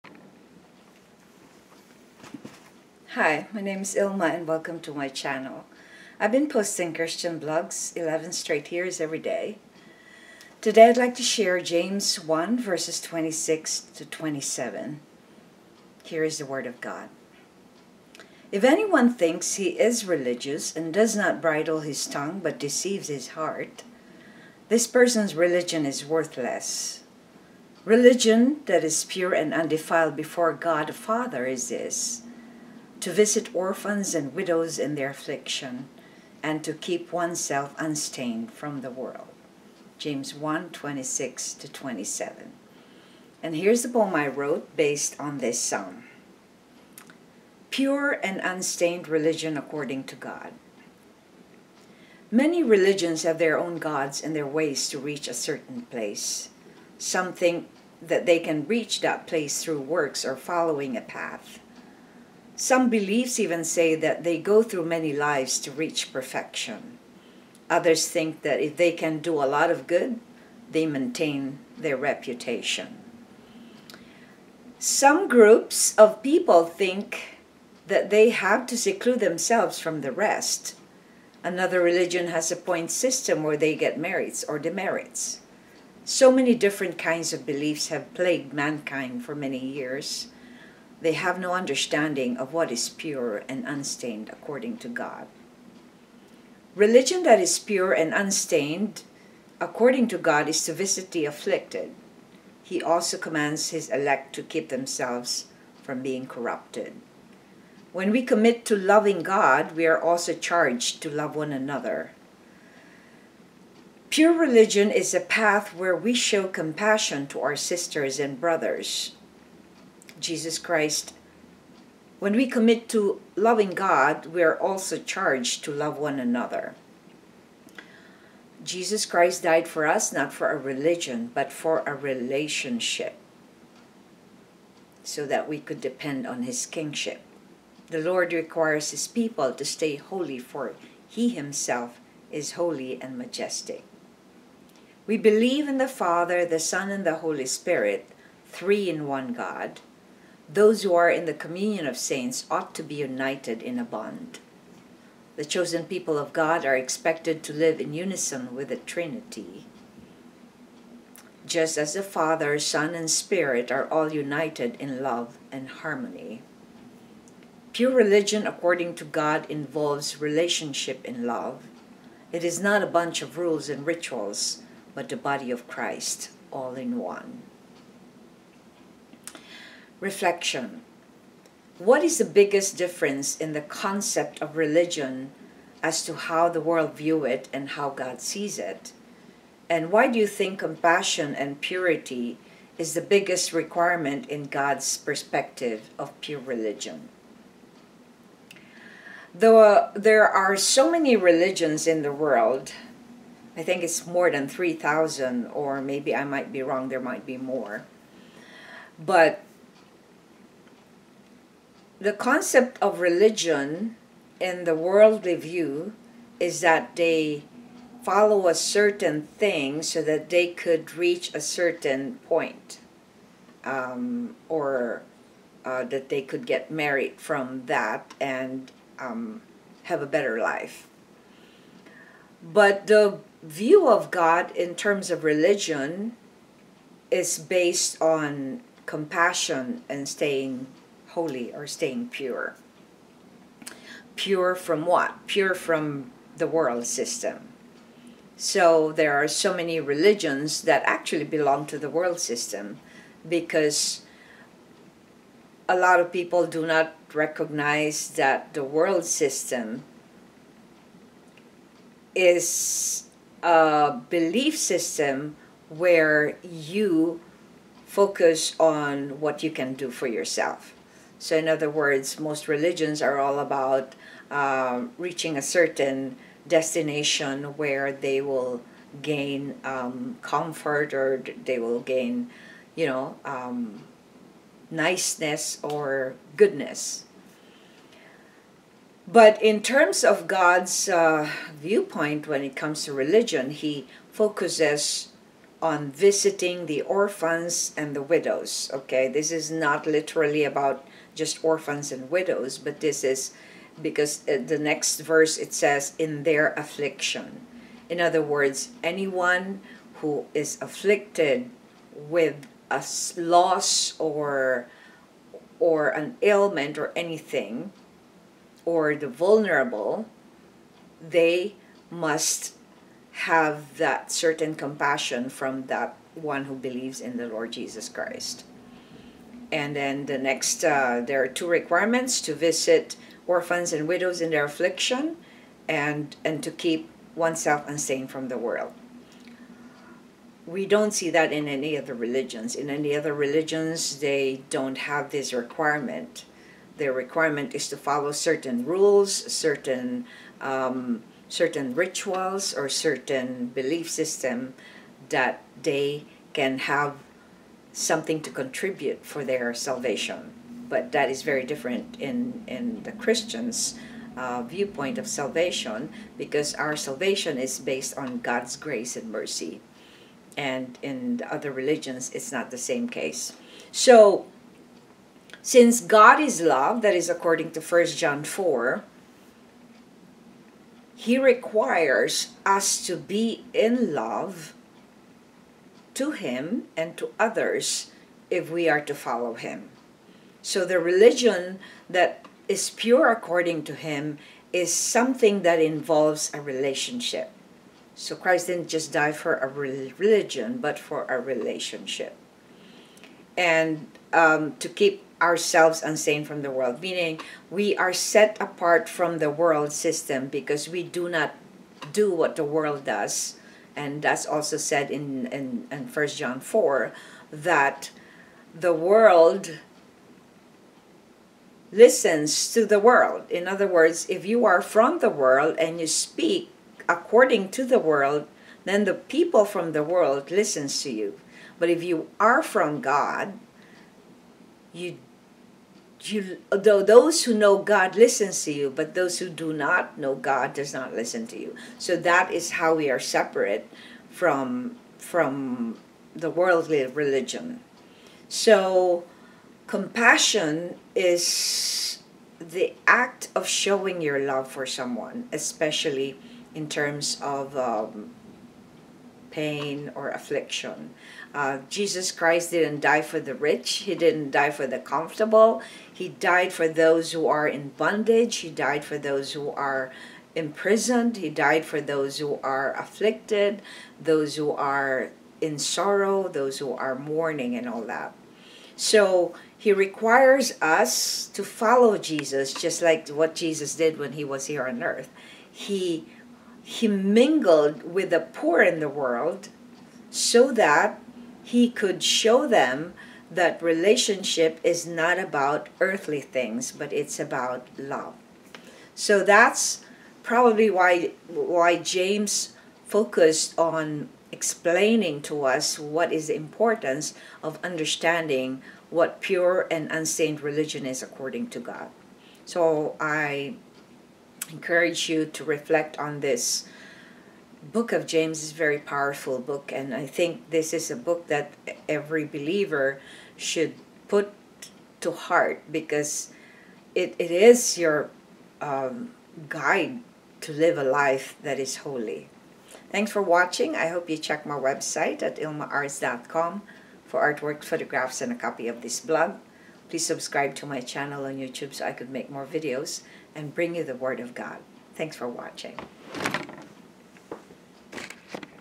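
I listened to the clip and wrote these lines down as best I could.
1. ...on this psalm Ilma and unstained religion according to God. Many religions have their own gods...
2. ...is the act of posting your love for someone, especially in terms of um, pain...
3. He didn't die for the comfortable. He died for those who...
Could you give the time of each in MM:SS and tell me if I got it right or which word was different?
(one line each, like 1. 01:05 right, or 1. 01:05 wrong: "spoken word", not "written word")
1. 00:45 wrong: "Pure", not "Ilma"
2. 07:30 wrong: "showing", not "posting"
3. 07:43 right.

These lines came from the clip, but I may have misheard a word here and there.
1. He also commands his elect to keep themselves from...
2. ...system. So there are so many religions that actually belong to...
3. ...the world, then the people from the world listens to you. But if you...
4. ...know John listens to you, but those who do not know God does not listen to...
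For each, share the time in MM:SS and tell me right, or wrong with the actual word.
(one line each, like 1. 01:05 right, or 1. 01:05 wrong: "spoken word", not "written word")
1. 01:42 right
2. 04:06 right
3. 07:07 right
4. 07:17 wrong: "God", not "John".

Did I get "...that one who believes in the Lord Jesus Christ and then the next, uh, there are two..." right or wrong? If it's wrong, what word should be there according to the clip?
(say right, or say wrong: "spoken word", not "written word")
right.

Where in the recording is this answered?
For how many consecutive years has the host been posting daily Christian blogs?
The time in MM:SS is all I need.
00:07.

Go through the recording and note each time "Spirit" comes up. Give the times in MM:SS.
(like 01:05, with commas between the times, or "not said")
02:27, 02:43.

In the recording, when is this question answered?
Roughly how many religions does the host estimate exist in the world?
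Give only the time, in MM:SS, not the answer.
03:24.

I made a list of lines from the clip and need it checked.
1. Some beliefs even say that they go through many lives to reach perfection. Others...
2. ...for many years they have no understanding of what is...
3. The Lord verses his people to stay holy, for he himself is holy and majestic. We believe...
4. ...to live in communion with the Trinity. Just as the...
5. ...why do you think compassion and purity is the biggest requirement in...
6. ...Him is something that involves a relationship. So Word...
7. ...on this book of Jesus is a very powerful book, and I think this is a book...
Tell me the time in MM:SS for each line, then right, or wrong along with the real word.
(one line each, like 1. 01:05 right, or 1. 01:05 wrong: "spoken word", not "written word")
1. 01:02 right
2. 01:29 right
3. 02:17 wrong: "requires", not "verses"
4. 02:37 wrong: "unison", not "communion"
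5. 03:09 right
6. 06:33 wrong: "Christ", not "Word"
7. 08:35 wrong: "James", not "Jesus".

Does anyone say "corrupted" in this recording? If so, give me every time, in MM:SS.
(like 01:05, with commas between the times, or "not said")
01:46.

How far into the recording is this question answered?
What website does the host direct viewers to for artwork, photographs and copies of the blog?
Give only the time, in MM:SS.
08:55.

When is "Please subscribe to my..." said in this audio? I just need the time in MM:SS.
08:59.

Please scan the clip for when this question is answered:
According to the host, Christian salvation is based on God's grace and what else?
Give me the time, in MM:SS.
06:09.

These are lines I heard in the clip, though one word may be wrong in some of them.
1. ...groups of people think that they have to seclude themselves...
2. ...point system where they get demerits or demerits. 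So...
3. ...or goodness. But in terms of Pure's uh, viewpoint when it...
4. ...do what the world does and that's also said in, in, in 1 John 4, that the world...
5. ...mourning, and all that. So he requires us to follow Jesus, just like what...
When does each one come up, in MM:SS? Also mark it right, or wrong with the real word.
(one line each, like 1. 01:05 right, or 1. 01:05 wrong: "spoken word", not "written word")
1. 01:15 right
2. 01:22 wrong: "merits", not "demerits"
3. 04:45 wrong: "God", not "Pure"
4. 06:51 right
5. 07:56 right.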